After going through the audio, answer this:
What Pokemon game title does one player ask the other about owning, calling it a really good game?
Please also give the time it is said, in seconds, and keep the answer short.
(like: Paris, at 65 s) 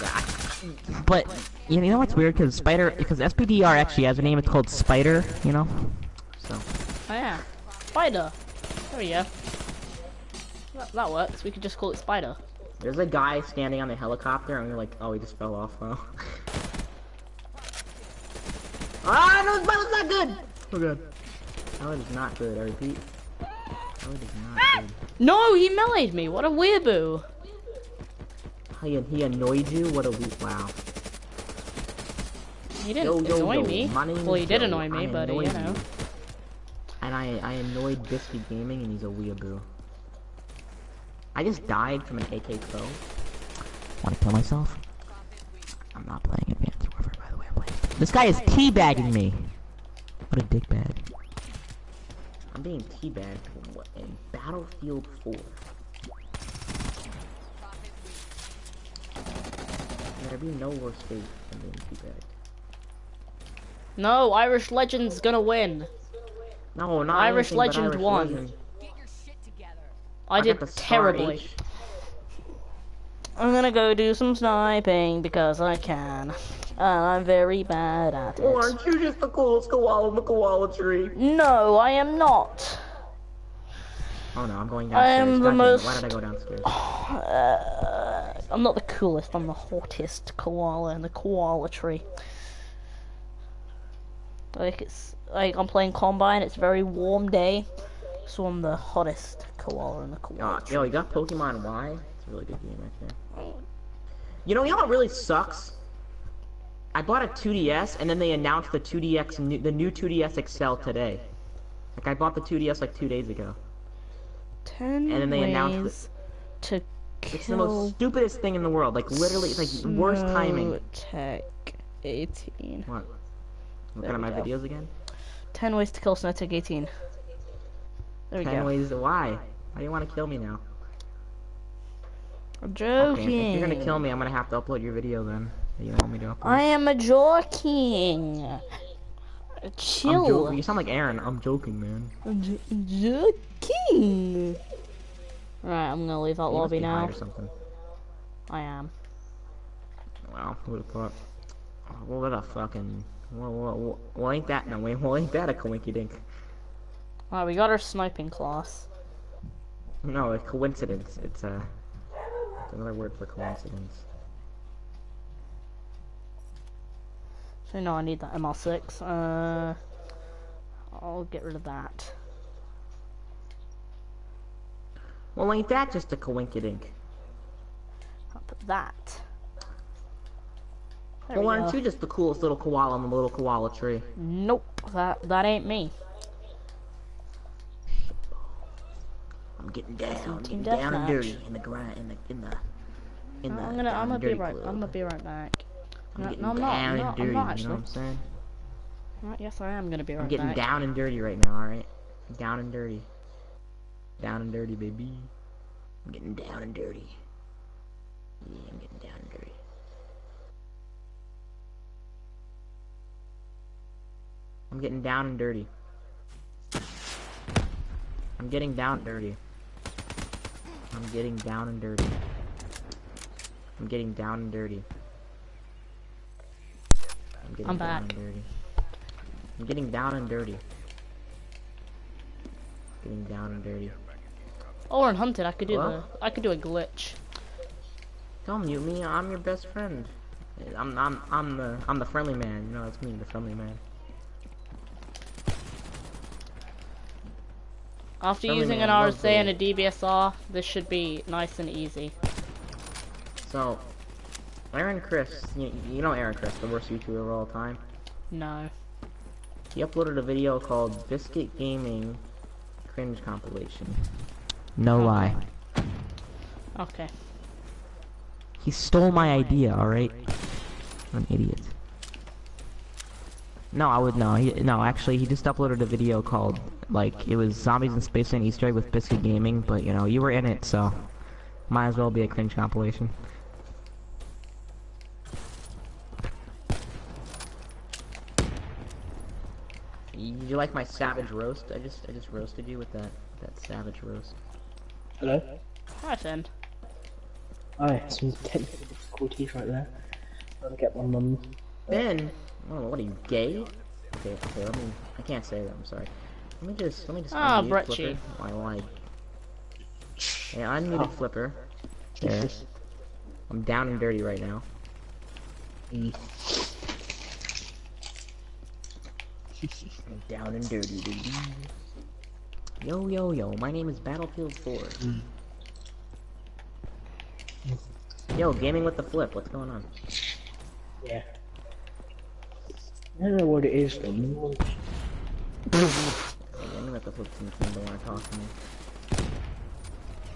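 Pokemon Y, at 101 s.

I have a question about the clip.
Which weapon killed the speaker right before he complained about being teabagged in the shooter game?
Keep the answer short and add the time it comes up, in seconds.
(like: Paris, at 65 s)
AK Pro, at 42 s.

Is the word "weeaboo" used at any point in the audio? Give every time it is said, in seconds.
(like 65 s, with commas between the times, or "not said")
26 s, 39 s.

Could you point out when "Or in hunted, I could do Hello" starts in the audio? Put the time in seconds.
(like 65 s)
234 s.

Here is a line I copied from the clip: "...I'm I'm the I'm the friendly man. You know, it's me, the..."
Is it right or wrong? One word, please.
right.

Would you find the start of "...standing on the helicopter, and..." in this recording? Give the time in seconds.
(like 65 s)
13 s.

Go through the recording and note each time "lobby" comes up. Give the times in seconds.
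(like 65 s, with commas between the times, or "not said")
146 s.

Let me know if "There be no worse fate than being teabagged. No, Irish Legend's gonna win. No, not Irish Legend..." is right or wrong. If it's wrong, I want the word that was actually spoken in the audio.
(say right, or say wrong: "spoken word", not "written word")
right.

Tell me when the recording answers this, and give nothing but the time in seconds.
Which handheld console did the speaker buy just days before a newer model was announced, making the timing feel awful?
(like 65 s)
106 s.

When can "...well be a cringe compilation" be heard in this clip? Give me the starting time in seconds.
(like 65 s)
281 s.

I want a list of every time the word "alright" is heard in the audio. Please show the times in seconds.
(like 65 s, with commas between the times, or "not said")
201 s, 269 s.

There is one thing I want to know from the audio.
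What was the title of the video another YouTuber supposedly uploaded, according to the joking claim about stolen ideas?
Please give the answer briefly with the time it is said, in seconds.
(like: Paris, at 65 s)
Biscuit Gaming Cringe Compilation, at 261 s.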